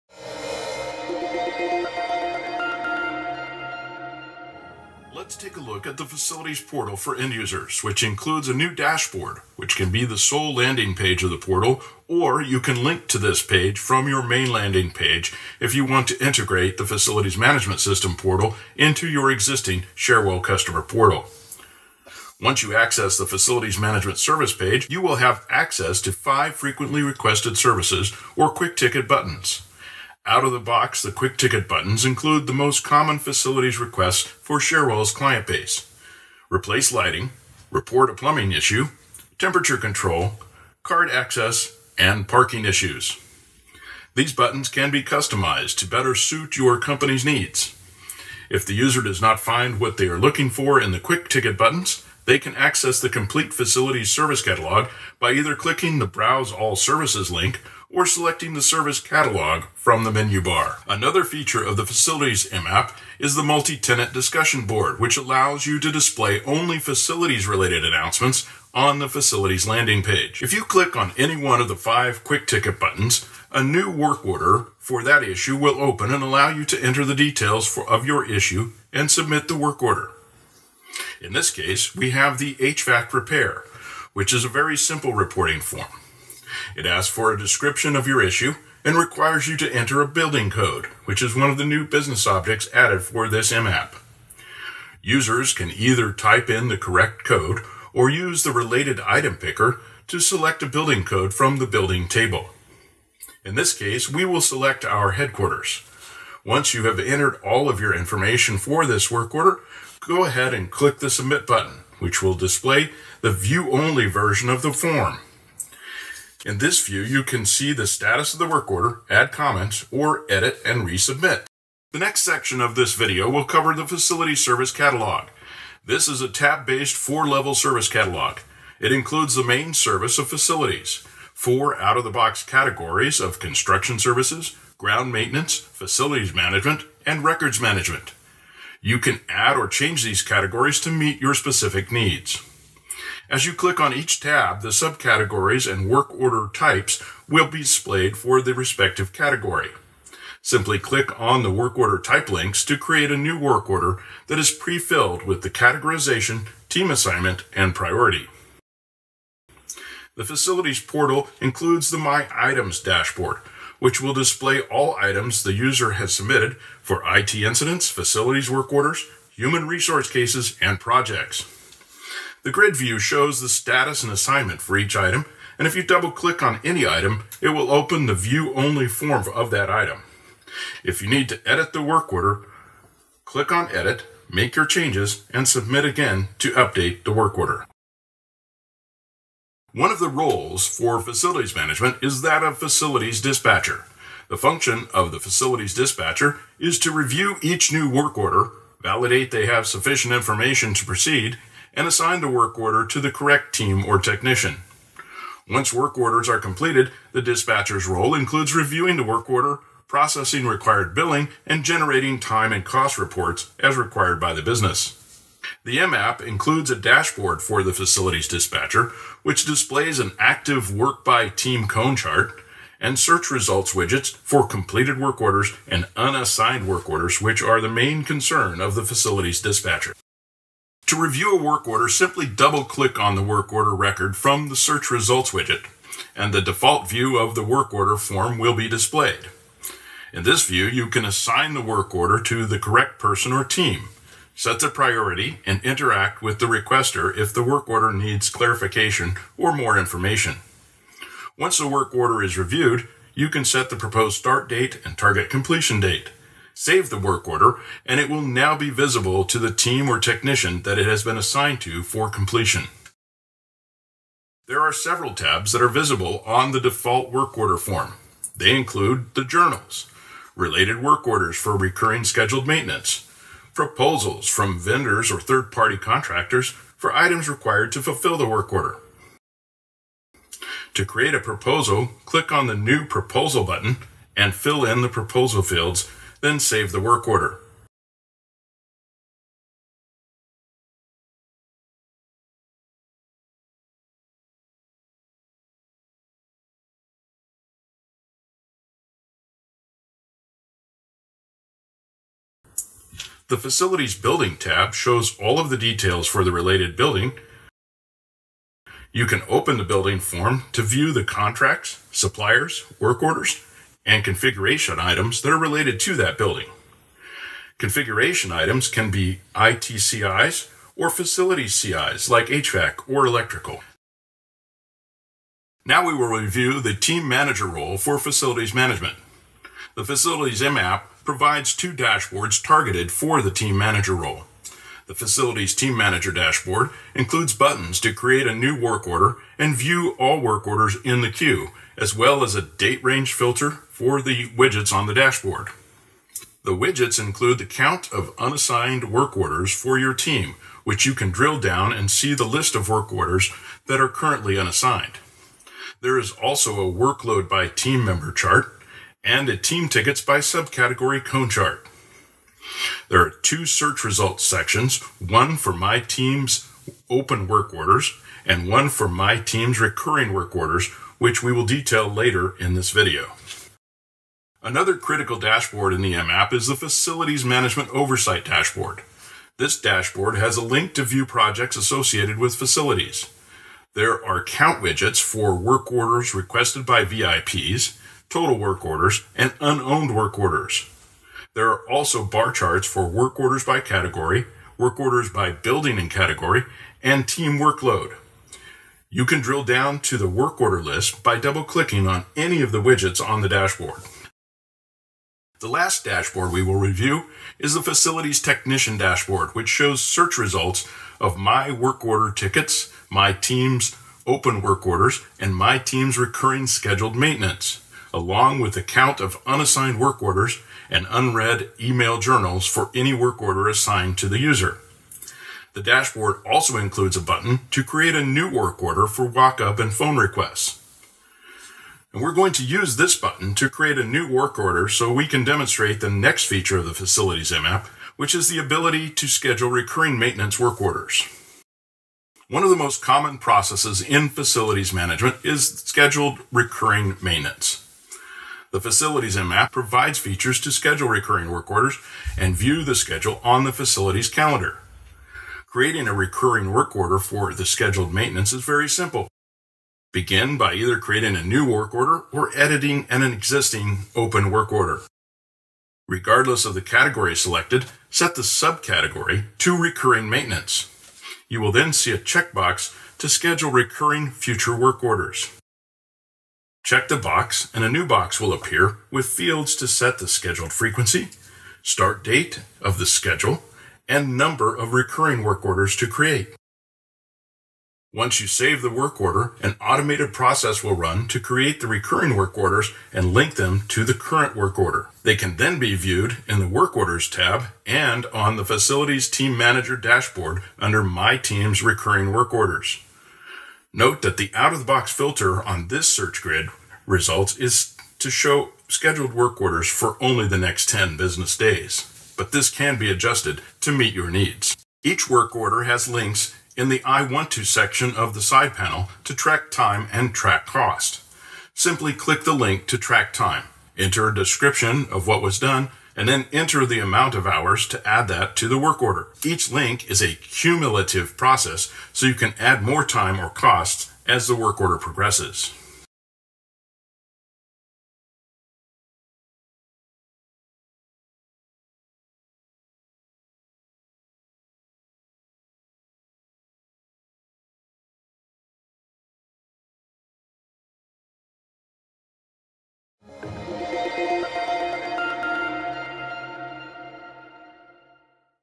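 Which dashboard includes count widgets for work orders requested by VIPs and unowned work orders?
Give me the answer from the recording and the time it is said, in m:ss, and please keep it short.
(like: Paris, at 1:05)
Facilities Management Oversight, at 6:16.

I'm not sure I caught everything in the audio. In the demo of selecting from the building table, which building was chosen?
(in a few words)
Headquarters.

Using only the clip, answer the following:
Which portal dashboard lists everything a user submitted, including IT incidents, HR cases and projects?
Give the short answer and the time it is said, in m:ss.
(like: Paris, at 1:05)
My Items, at 2:41.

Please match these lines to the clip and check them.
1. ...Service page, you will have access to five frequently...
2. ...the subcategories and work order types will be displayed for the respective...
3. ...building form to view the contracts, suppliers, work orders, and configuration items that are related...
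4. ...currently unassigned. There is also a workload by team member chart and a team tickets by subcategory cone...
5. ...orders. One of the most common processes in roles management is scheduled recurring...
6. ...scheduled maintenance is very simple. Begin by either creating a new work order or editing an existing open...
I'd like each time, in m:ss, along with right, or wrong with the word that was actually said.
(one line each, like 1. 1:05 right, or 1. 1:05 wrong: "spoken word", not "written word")
1. 0:24 right
2. 2:24 right
3. 5:09 right
4. 5:53 right
5. 7:20 wrong: "facilities", not "roles"
6. 7:37 right.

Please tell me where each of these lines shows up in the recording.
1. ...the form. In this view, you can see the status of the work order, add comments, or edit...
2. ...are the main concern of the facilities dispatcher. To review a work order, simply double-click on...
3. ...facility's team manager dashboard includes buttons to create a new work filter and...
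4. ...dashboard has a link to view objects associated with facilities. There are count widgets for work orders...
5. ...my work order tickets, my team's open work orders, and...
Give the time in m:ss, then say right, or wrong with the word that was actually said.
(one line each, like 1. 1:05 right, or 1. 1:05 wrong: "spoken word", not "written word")
1. 1:54 right
2. 3:47 right
3. 5:35 wrong: "order", not "filter"
4. 6:19 wrong: "projects", not "objects"
5. 6:51 right.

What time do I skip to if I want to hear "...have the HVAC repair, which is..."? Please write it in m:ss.
1:22.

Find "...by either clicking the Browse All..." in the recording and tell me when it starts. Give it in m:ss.
0:55.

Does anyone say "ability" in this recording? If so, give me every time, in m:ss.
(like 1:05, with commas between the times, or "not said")
7:18.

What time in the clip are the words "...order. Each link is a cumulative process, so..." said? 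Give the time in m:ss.
8:48.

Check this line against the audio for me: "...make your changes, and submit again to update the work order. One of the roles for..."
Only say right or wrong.
right.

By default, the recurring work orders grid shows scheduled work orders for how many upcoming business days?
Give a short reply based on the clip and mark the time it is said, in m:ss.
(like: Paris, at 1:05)
10, at 8:30.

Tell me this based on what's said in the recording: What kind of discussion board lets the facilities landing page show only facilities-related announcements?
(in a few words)
Multi-tenant.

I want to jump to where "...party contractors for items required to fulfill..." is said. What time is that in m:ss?
4:35.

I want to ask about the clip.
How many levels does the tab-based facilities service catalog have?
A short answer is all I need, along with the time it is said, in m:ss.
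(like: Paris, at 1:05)
4, at 2:06.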